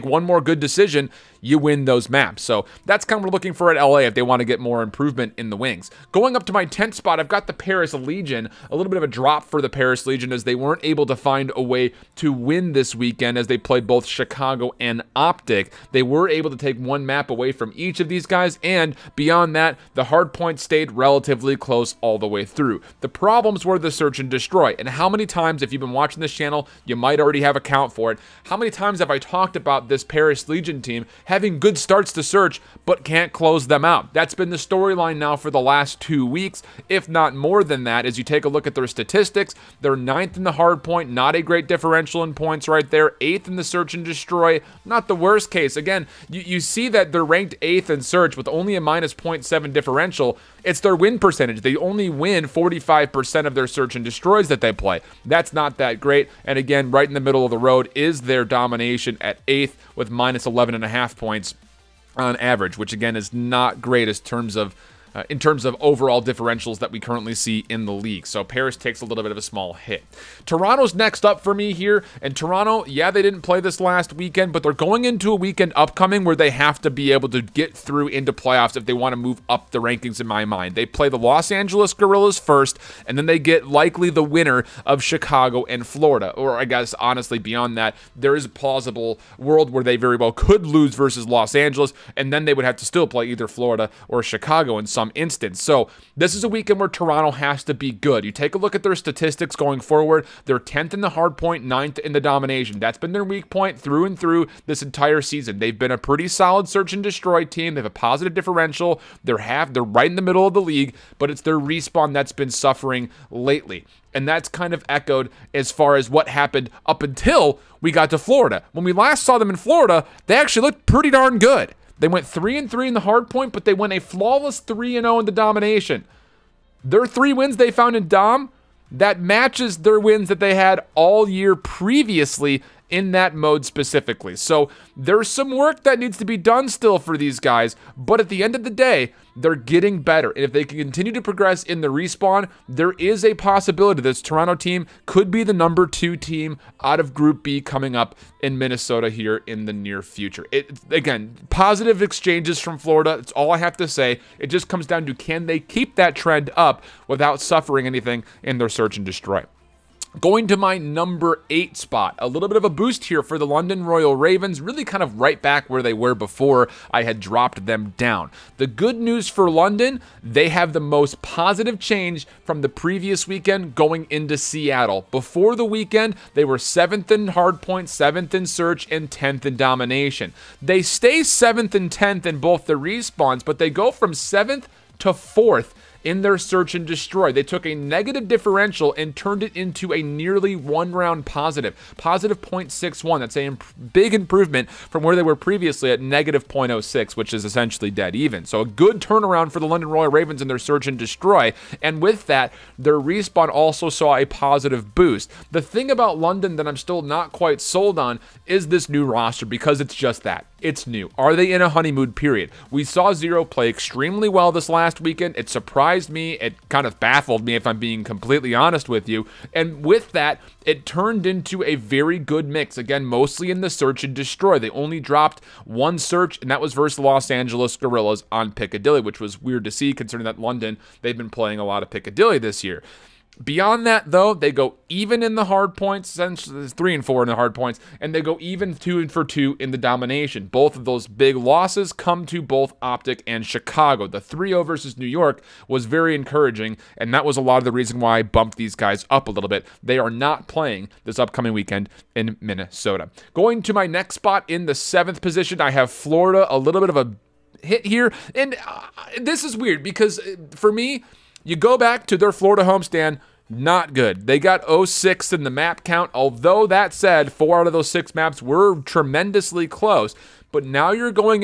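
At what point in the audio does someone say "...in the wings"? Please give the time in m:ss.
0:05.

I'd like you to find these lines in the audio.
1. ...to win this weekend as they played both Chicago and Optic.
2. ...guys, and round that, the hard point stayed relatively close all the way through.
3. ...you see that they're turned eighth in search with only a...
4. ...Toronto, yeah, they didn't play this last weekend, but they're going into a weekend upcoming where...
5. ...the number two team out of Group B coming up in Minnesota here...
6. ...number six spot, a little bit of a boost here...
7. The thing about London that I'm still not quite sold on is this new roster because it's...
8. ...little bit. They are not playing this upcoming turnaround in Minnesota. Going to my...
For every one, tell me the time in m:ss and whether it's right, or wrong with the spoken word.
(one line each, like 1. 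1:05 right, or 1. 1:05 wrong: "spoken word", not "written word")
1. 0:12 right
2. 0:18 wrong: "beyond", not "round"
3. 0:46 wrong: "ranked", not "turned"
4. 1:12 right
5. 2:25 right
6. 2:40 wrong: "eight", not "six"
7. 3:25 right
8. 4:09 wrong: "weekend", not "turnaround".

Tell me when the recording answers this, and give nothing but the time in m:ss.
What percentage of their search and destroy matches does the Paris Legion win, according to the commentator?
0:52.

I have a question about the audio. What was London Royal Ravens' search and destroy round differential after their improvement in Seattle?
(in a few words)
+0.61.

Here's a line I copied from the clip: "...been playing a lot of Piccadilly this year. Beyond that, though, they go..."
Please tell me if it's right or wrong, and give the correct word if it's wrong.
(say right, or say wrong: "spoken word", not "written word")
right.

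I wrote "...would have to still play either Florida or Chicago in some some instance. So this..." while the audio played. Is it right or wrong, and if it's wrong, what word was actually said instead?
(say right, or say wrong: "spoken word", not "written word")
right.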